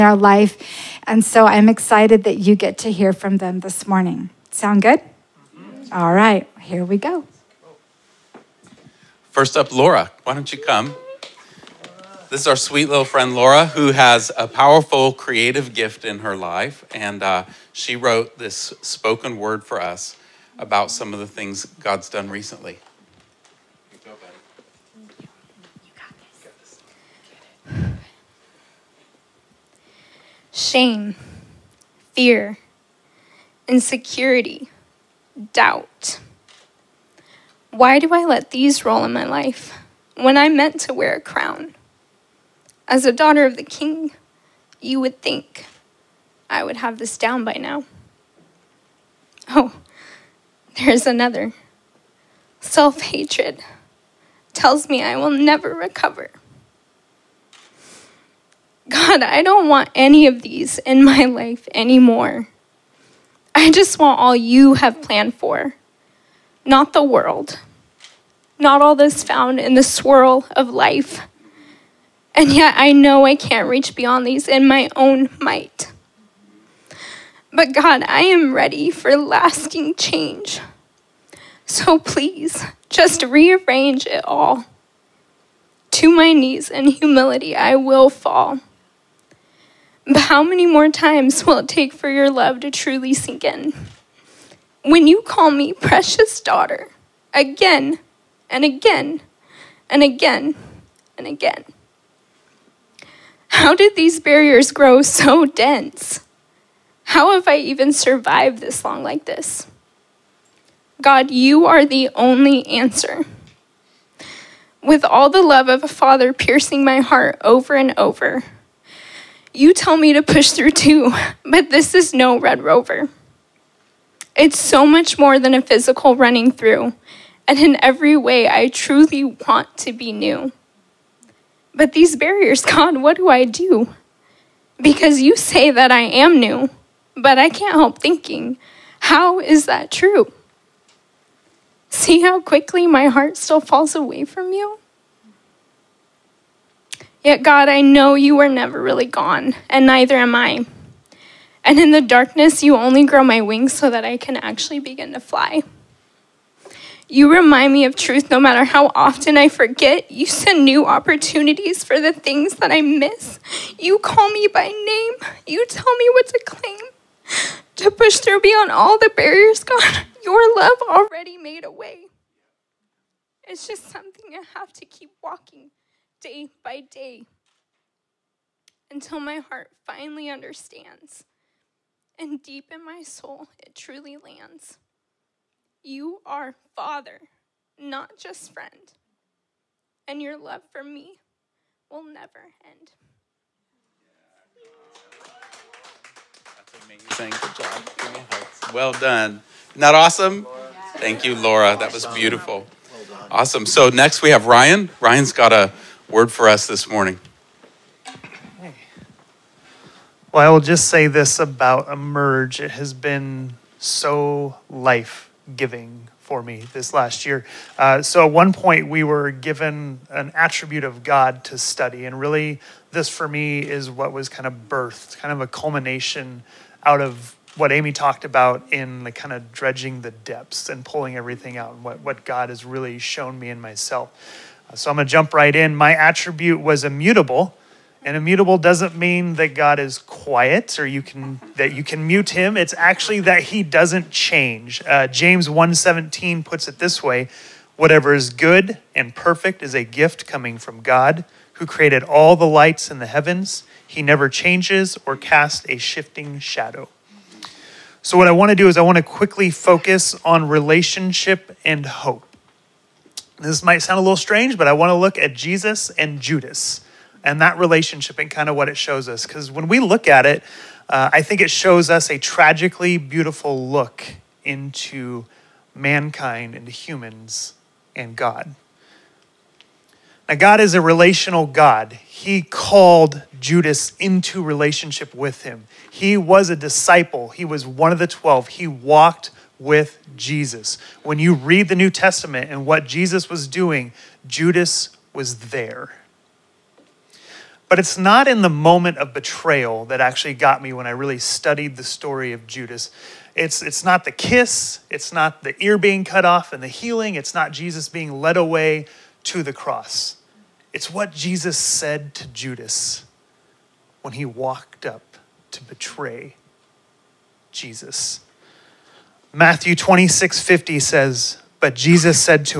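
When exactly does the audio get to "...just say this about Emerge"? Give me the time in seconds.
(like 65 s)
210 s.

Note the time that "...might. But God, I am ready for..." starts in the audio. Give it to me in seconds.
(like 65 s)
75 s.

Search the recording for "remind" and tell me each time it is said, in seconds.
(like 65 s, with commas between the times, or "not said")
157 s.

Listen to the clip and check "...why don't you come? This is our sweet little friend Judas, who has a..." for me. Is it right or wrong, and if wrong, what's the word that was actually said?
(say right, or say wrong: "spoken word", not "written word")
wrong: "Laura", not "Judas".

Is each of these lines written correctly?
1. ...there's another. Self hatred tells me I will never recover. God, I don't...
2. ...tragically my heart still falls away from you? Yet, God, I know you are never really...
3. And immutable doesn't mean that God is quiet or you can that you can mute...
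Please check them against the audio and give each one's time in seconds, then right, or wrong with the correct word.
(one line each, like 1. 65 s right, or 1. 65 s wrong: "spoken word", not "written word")
1. 50 s right
2. 142 s wrong: "quickly", not "tragically"
3. 238 s right.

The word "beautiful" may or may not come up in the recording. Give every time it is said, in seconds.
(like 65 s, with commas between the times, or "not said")
202 s, 272 s.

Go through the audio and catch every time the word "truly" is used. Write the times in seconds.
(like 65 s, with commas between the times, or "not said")
92 s, 128 s, 183 s.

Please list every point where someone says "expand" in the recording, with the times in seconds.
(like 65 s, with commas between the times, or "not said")
not said.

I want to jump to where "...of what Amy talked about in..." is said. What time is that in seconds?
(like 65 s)
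226 s.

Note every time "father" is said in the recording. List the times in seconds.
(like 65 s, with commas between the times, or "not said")
115 s, 186 s.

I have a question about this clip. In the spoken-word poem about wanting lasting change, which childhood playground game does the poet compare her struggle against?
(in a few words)
Red Rover.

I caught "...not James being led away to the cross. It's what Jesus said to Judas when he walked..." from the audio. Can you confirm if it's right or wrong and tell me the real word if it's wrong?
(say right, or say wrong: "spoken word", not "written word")
wrong: "Jesus", not "James".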